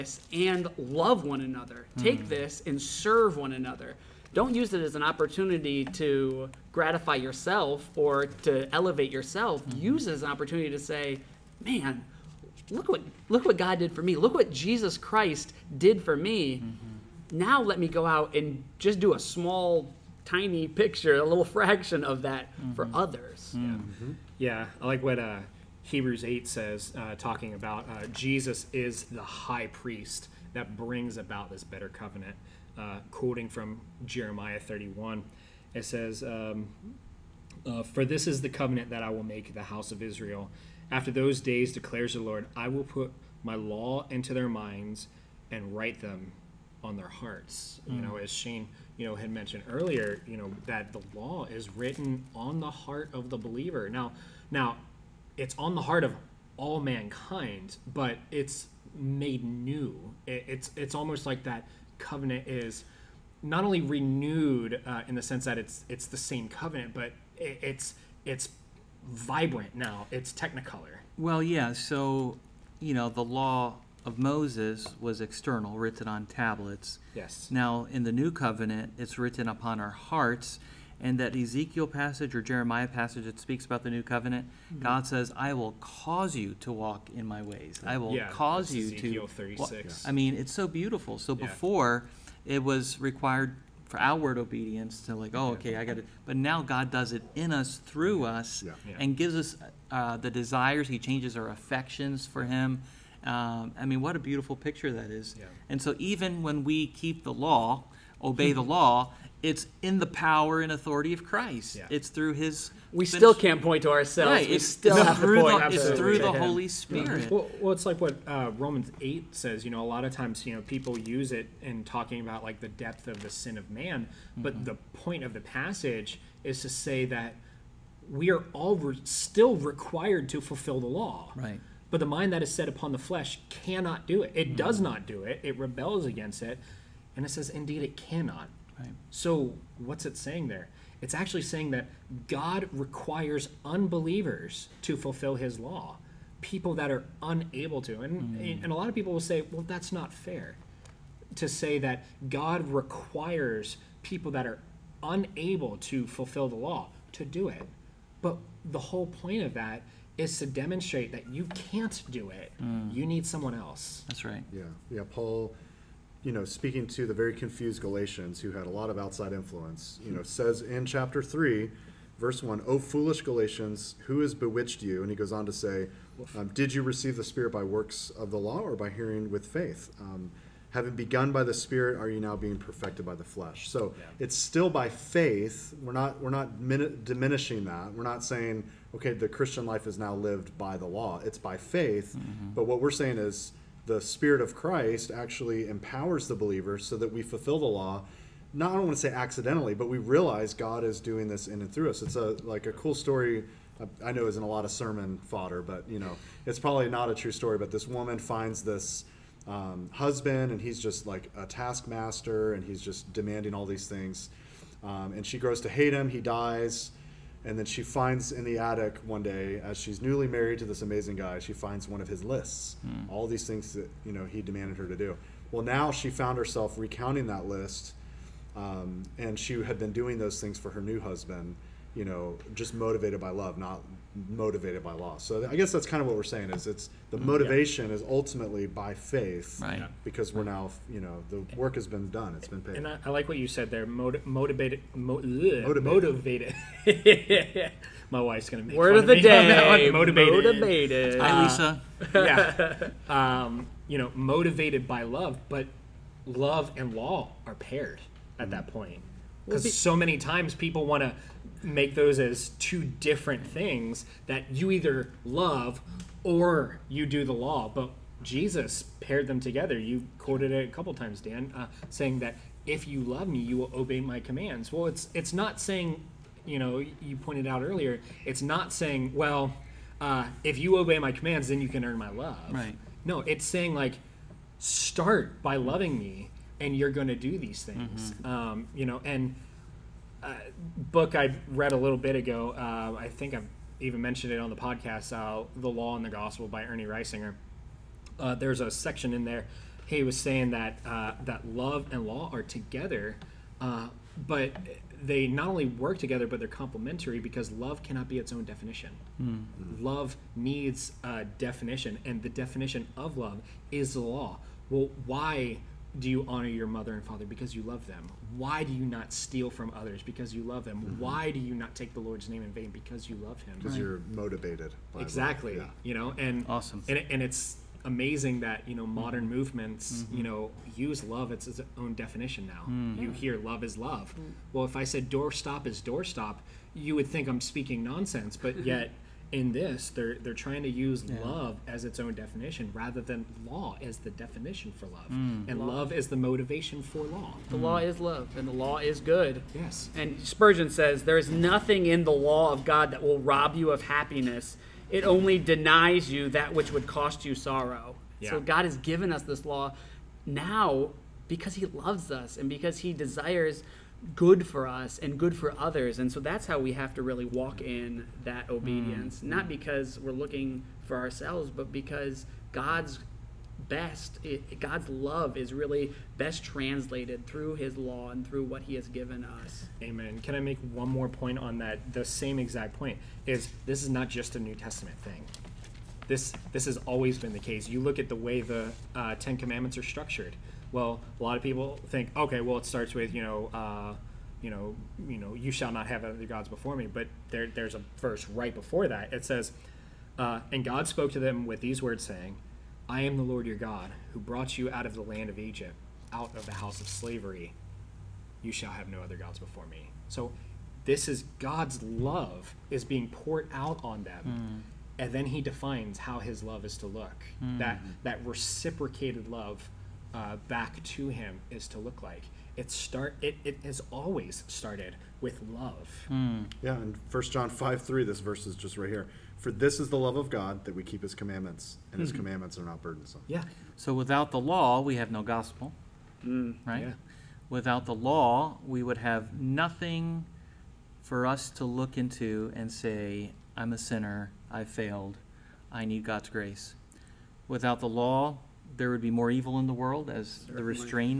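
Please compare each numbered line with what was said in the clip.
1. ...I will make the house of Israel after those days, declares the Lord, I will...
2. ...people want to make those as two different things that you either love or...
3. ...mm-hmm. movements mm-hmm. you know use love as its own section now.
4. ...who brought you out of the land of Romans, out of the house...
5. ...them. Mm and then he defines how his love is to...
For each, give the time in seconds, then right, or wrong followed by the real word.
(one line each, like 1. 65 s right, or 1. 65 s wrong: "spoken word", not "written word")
1. 39 s right
2. 260 s right
3. 329 s wrong: "definition", not "section"
4. 404 s wrong: "Egypt", not "Romans"
5. 414 s right.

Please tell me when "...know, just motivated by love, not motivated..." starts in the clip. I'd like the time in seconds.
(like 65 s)
232 s.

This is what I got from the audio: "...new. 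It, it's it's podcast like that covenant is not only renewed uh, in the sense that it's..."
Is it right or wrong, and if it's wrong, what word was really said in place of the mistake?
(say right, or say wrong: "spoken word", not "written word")
wrong: "almost", not "podcast".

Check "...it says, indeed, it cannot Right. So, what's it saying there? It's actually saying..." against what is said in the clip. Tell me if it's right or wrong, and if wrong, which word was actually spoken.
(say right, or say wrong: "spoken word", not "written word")
right.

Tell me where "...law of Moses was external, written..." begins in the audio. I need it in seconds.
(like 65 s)
73 s.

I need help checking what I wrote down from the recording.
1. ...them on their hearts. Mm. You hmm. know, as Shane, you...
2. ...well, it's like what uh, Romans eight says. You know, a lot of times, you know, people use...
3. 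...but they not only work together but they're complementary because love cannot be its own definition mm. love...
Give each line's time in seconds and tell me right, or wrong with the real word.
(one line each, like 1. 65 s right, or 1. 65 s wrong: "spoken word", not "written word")
1. 46 s right
2. 117 s right
3. 304 s right.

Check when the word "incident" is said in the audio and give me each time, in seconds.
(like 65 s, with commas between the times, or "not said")
not said.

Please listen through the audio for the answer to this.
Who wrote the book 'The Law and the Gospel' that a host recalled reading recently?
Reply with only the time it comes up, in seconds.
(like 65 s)
296 s.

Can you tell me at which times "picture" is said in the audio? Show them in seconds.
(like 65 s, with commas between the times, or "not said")
20 s, 104 s.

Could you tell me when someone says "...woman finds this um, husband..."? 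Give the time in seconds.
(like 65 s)
207 s.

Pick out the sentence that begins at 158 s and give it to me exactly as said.
But the whole point of that is to demonstrate that you can't do it.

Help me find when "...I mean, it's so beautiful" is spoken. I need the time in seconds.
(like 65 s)
90 s.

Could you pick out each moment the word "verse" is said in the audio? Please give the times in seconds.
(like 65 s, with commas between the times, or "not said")
172 s, 397 s, 428 s.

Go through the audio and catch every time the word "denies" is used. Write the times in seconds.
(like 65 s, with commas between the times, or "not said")
355 s.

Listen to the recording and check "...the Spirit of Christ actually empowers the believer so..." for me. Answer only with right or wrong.
right.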